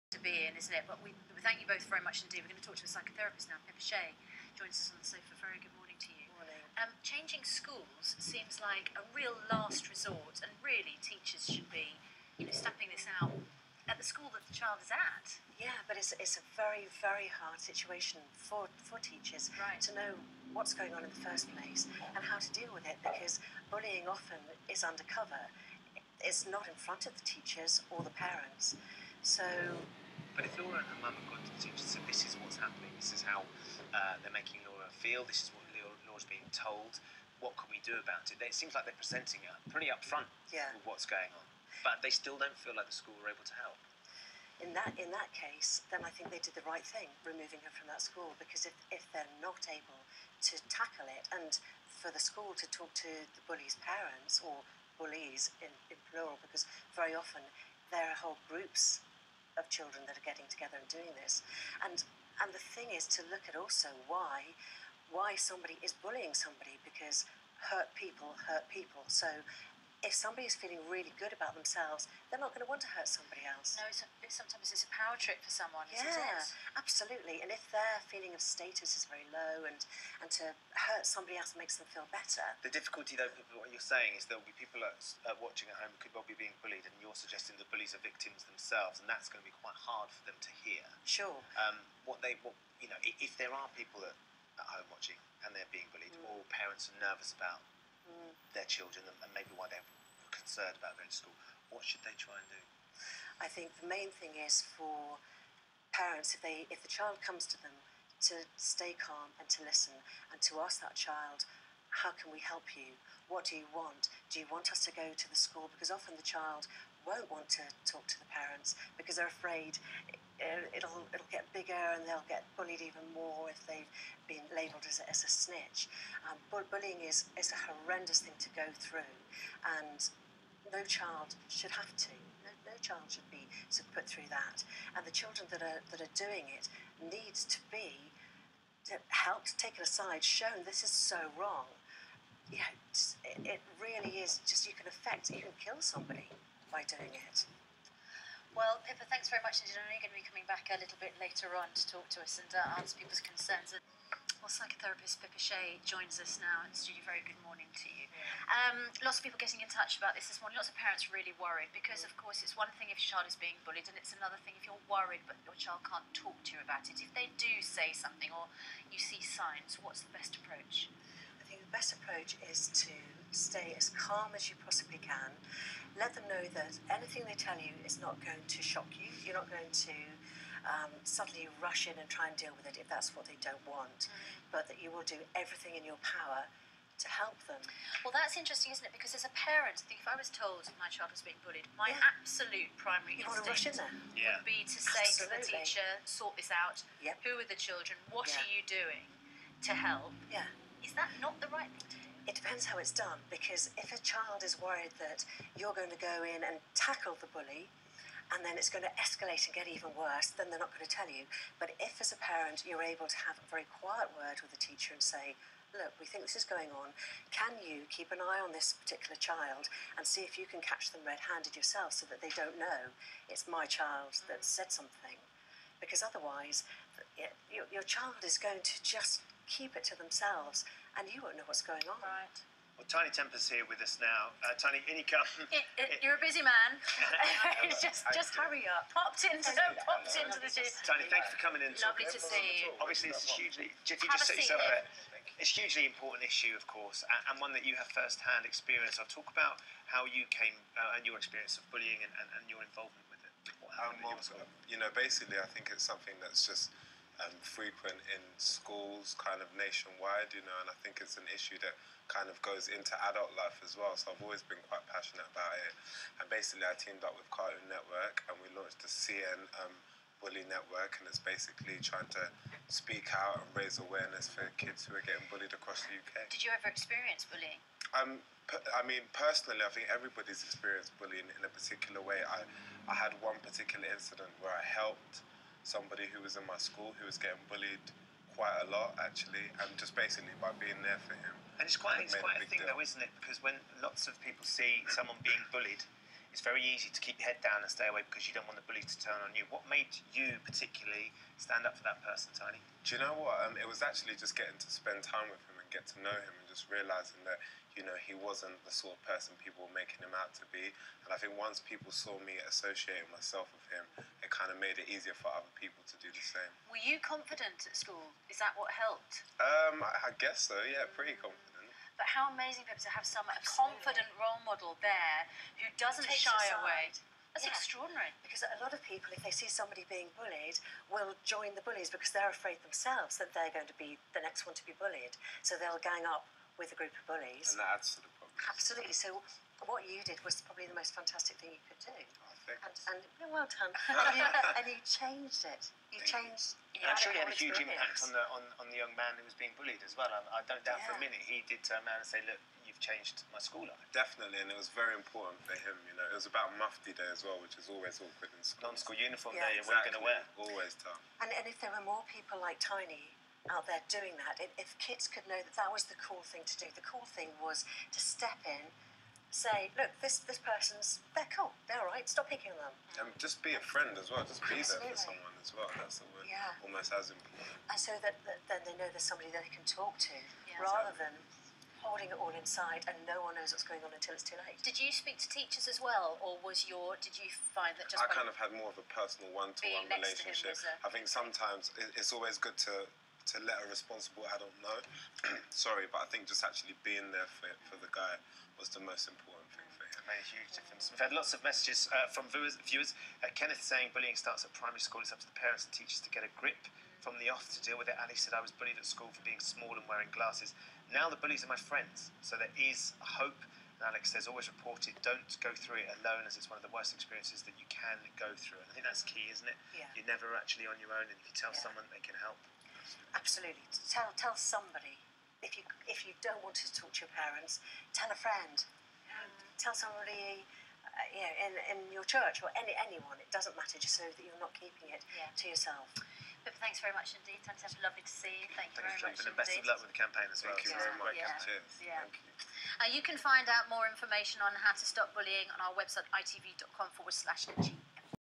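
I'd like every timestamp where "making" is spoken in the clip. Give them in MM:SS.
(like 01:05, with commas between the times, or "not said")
00:34, 05:09.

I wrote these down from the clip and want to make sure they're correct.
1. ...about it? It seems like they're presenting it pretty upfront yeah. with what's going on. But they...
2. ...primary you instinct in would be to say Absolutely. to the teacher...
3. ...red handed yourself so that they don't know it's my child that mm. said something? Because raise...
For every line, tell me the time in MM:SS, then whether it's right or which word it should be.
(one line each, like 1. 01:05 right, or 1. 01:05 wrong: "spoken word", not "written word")
1. 00:37 right
2. 03:12 right
3. 03:41 wrong: "otherwise", not "raise".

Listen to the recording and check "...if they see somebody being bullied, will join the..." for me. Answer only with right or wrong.
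right.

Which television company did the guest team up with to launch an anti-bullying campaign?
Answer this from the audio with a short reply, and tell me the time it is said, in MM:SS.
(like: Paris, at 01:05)
Cartoon Network, at 04:27.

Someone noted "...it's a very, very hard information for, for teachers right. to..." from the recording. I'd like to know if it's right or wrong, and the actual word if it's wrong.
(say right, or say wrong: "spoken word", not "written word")
wrong: "situation", not "information".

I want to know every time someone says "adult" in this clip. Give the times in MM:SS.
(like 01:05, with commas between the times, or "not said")
04:23, 06:34.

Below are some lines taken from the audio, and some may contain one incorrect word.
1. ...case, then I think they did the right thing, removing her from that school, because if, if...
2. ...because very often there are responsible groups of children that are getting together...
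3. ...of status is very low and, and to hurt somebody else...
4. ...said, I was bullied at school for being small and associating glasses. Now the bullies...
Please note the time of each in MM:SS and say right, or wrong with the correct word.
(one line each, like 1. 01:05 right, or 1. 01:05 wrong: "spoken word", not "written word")
1. 00:45 right
2. 00:56 wrong: "whole", not "responsible"
3. 01:18 right
4. 06:48 wrong: "wearing", not "associating".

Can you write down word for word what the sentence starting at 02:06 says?
Um, bullying is, is a horrendous thing to go through, and no child should have to.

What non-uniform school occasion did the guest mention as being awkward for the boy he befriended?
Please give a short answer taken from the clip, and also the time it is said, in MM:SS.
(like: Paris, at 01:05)
Mufti Day, at 05:56.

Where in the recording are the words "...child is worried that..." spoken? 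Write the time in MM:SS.
03:24.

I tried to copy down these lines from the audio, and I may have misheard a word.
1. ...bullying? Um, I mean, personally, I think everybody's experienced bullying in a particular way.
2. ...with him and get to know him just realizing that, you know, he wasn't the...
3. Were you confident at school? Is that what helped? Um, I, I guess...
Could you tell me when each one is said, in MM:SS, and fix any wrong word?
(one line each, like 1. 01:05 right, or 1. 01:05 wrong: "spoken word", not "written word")
1. 04:37 right
2. 05:05 right
3. 05:16 right.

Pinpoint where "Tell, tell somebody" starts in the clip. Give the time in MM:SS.
07:03.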